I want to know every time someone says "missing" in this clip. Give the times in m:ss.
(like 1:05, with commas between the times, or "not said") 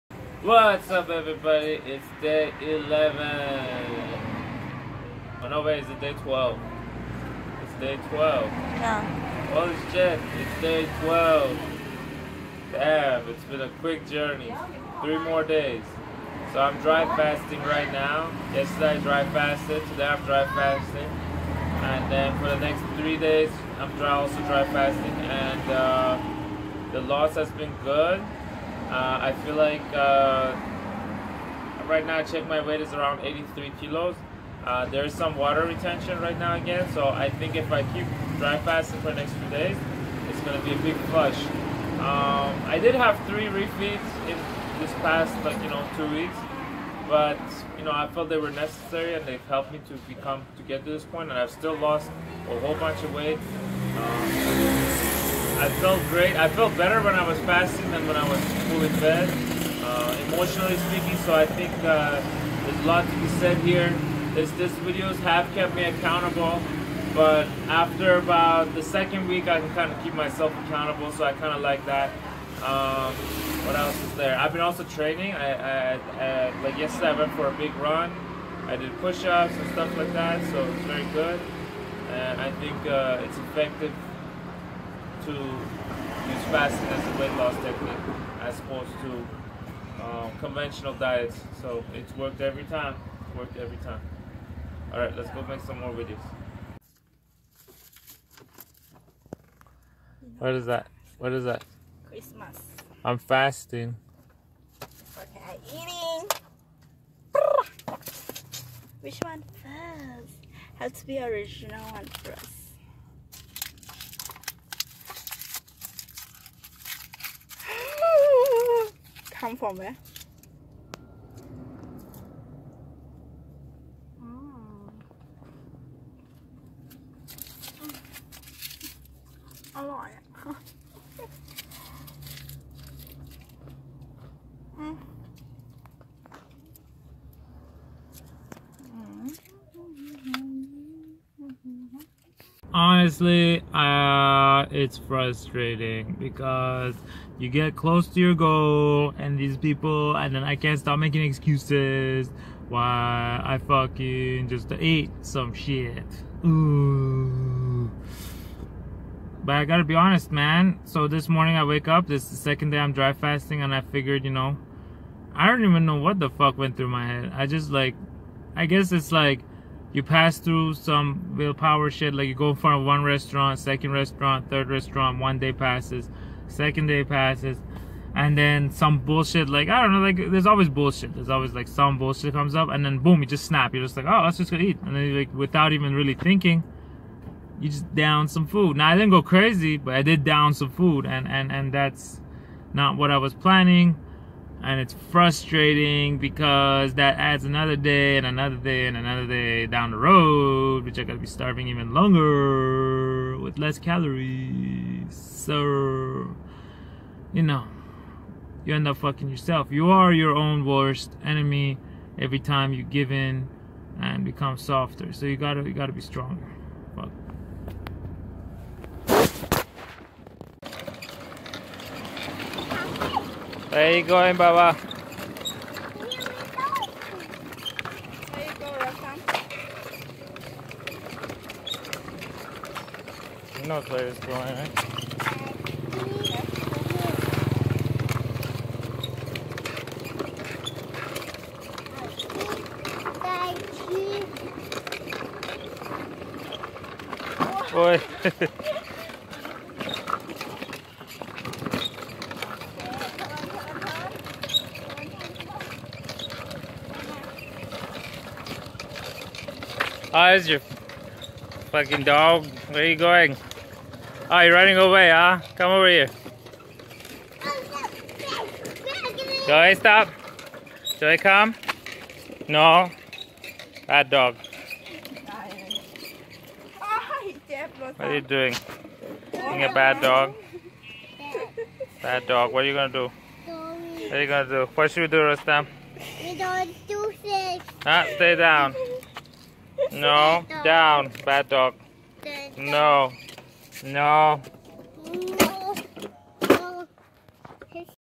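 not said.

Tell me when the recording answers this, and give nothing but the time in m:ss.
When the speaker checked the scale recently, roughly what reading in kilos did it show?
0:33.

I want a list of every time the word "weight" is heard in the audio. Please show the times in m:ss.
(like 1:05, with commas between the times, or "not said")
0:32, 0:53, 1:27.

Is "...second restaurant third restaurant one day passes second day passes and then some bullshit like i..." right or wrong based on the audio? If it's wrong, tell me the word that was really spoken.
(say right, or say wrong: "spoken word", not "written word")
right.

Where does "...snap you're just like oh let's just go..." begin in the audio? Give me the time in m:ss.
3:03.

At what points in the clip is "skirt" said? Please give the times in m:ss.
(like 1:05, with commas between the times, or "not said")
not said.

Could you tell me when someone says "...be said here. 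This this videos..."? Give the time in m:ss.
1:03.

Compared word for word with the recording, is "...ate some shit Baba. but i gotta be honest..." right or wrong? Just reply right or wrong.
wrong.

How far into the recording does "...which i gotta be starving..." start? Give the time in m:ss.
3:20.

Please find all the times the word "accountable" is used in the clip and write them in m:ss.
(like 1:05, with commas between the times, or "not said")
1:05, 1:10.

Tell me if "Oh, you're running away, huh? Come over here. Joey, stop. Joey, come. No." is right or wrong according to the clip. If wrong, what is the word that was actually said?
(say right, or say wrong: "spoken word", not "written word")
right.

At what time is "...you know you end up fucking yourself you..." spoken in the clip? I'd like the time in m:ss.
3:27.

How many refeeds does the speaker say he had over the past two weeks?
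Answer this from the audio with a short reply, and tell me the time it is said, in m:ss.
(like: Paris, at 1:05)
3, at 0:43.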